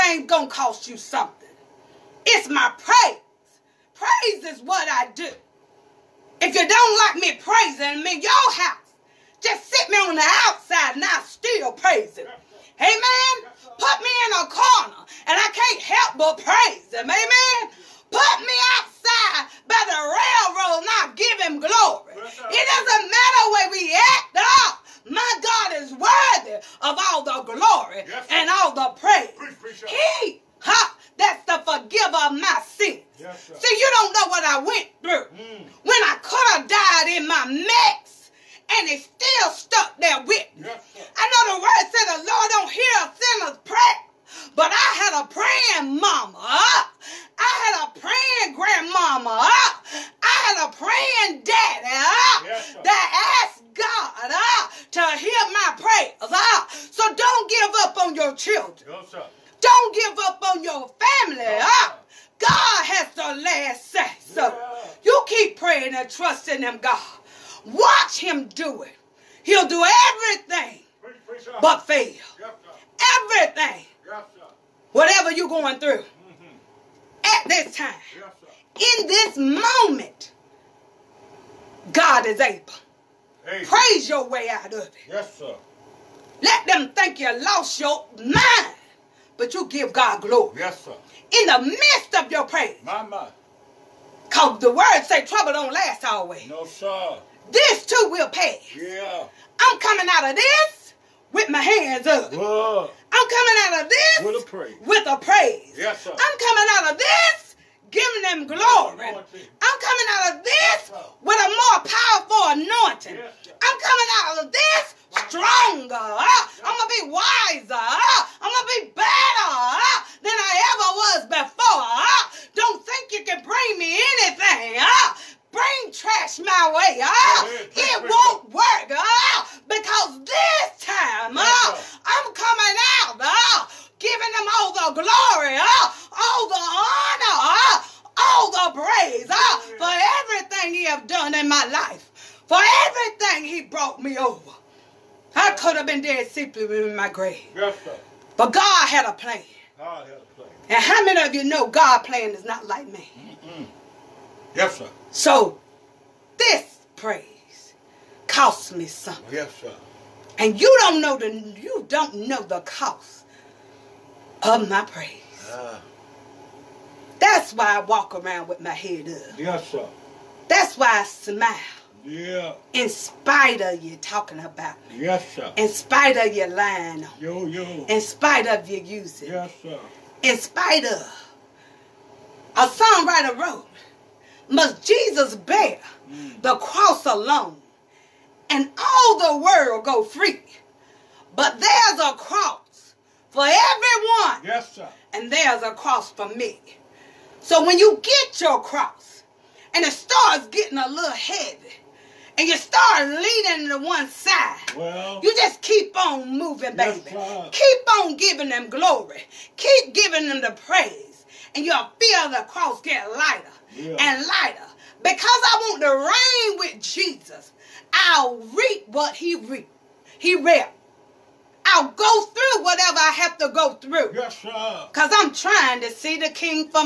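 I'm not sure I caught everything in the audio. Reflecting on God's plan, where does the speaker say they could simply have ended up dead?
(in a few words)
my grave.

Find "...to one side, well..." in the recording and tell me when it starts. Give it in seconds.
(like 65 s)
203 s.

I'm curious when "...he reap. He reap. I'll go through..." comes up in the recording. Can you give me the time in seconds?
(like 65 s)
219 s.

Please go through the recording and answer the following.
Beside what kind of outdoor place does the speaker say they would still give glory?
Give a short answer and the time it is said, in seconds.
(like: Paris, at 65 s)
railroad, at 20 s.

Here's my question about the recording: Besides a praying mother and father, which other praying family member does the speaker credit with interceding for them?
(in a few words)
grandmama.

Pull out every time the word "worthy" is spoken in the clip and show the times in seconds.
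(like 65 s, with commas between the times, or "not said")
25 s.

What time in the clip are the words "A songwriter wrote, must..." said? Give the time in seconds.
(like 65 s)
182 s.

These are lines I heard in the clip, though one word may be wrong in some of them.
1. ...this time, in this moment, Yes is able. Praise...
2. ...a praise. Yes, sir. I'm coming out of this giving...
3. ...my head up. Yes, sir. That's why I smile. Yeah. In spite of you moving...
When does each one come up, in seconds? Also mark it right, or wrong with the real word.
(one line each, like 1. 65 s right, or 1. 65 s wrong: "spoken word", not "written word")
1. 77 s wrong: "God", not "Yes"
2. 105 s right
3. 168 s wrong: "talking", not "moving".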